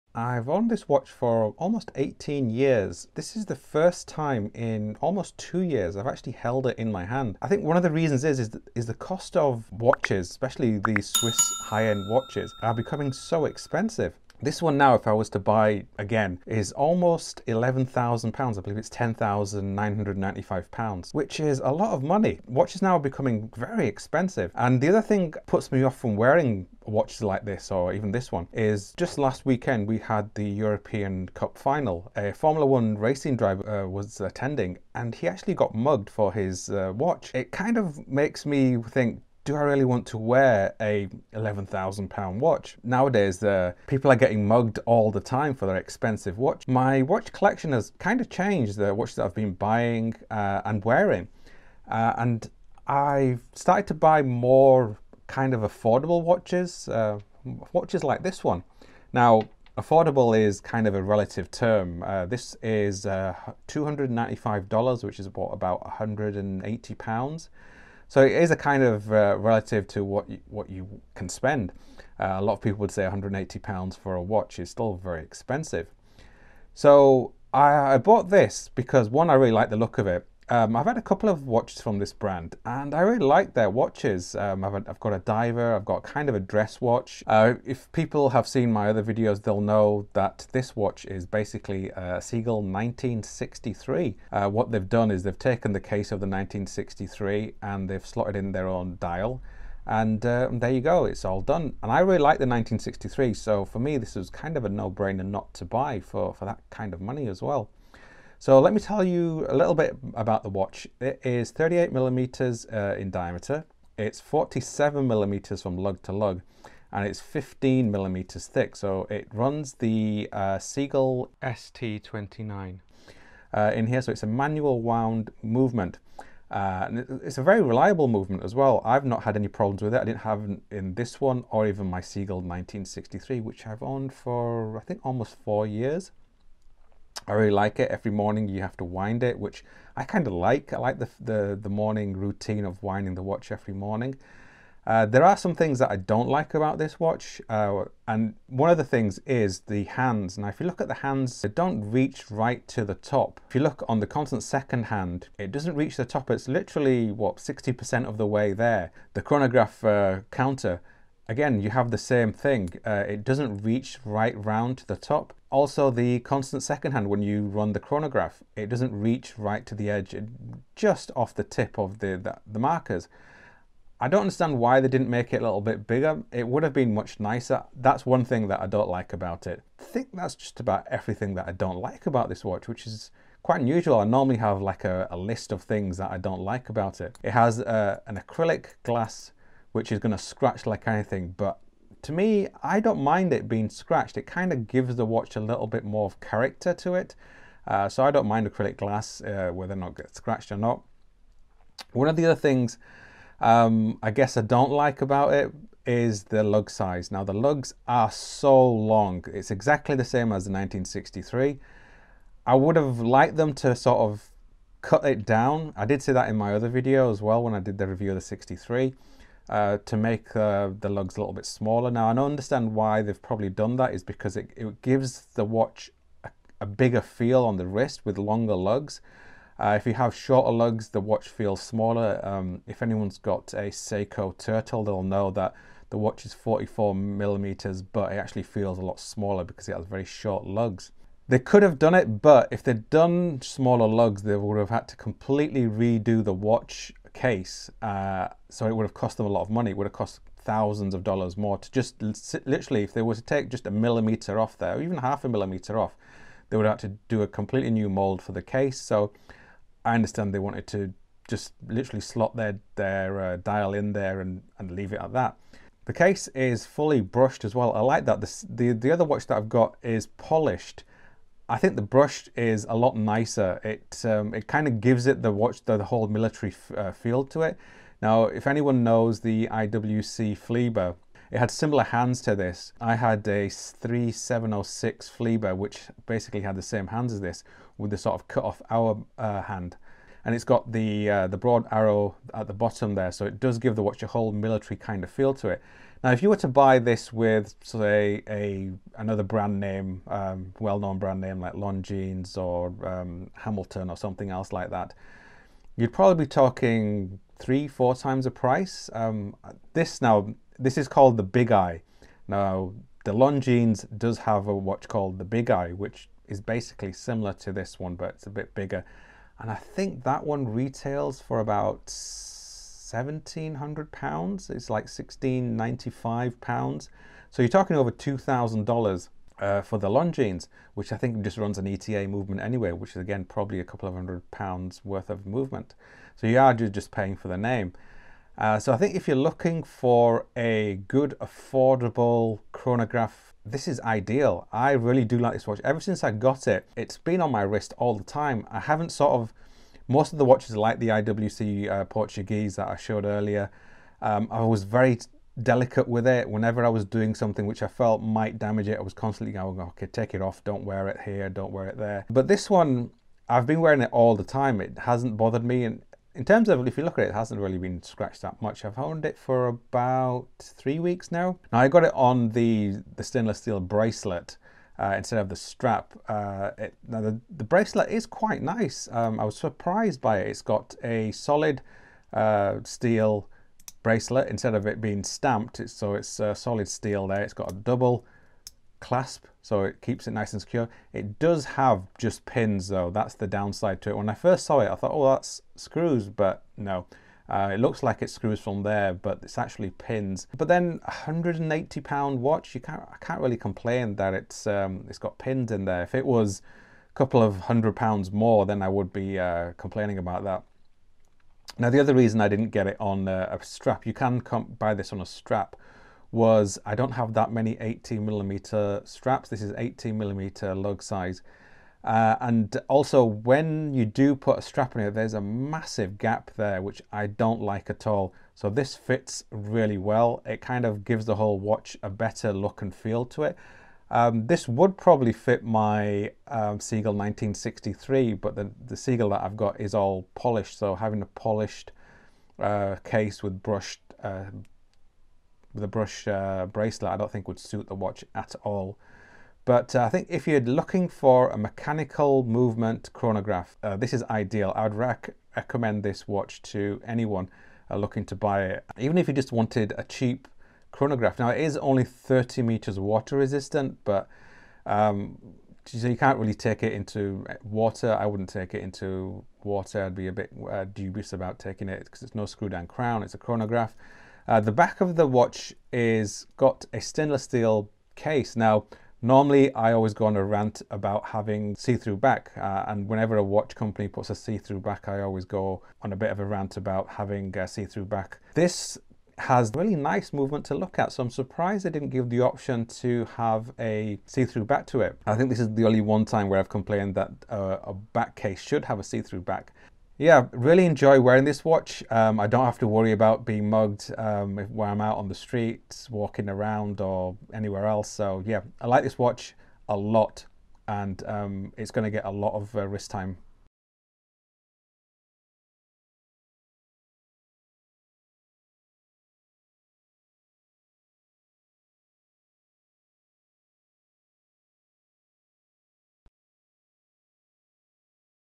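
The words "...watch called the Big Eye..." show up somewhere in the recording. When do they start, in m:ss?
5:14.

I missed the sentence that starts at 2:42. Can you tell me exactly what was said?
Uh, it doesn't reach right round to the top.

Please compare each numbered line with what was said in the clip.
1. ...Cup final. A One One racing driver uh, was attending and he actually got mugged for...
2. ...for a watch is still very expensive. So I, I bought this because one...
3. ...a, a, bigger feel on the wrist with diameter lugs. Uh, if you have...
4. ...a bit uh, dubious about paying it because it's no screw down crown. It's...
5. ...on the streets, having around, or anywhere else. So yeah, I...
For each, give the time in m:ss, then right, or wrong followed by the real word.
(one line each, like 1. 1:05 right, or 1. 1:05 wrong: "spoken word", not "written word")
1. 0:31 wrong: "Formula", not "One"
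2. 1:13 right
3. 3:46 wrong: "longer", not "diameter"
4. 7:50 wrong: "taking", not "paying"
5. 8:24 wrong: "walking", not "having".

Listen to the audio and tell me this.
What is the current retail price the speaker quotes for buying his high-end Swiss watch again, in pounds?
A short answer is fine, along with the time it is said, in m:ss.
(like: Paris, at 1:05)
£10,995, at 0:18.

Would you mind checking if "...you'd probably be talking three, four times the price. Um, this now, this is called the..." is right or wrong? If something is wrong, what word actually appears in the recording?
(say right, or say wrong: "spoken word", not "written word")
right.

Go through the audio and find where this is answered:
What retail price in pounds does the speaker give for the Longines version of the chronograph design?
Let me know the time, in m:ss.
5:24.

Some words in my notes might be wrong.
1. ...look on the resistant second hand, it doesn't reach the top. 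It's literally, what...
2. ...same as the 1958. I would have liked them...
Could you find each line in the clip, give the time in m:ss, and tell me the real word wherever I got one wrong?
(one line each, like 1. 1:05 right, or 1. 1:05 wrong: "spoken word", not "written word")
1. 2:33 wrong: "constant", not "resistant"
2. 3:30 wrong: "1963", not "1958".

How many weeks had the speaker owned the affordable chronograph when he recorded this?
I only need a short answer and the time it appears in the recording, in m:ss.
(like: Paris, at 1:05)
3 weeks, at 6:10.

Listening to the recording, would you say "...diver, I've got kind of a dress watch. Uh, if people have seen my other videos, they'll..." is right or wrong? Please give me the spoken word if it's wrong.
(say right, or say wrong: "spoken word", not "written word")
right.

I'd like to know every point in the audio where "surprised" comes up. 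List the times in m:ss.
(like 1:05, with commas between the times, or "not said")
6:19, 8:11.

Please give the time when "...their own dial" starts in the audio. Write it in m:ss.
1:38.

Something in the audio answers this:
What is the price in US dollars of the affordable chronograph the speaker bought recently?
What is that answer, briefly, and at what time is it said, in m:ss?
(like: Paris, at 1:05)
$295, at 1:03.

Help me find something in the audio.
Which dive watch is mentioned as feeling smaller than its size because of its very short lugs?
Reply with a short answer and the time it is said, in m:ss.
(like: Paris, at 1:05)
Seiko Turtle, at 3:53.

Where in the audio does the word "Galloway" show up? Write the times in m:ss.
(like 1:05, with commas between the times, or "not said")
not said.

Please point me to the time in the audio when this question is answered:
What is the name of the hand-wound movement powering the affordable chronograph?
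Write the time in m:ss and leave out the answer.
2:00.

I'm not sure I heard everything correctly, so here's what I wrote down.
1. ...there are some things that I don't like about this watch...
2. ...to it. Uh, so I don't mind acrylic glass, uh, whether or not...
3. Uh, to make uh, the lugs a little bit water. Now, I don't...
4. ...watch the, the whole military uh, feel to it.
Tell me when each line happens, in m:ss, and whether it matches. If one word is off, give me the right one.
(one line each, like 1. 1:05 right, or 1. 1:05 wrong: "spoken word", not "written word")
1. 2:25 right
2. 3:16 right
3. 3:39 wrong: "smaller", not "water"
4. 4:35 right.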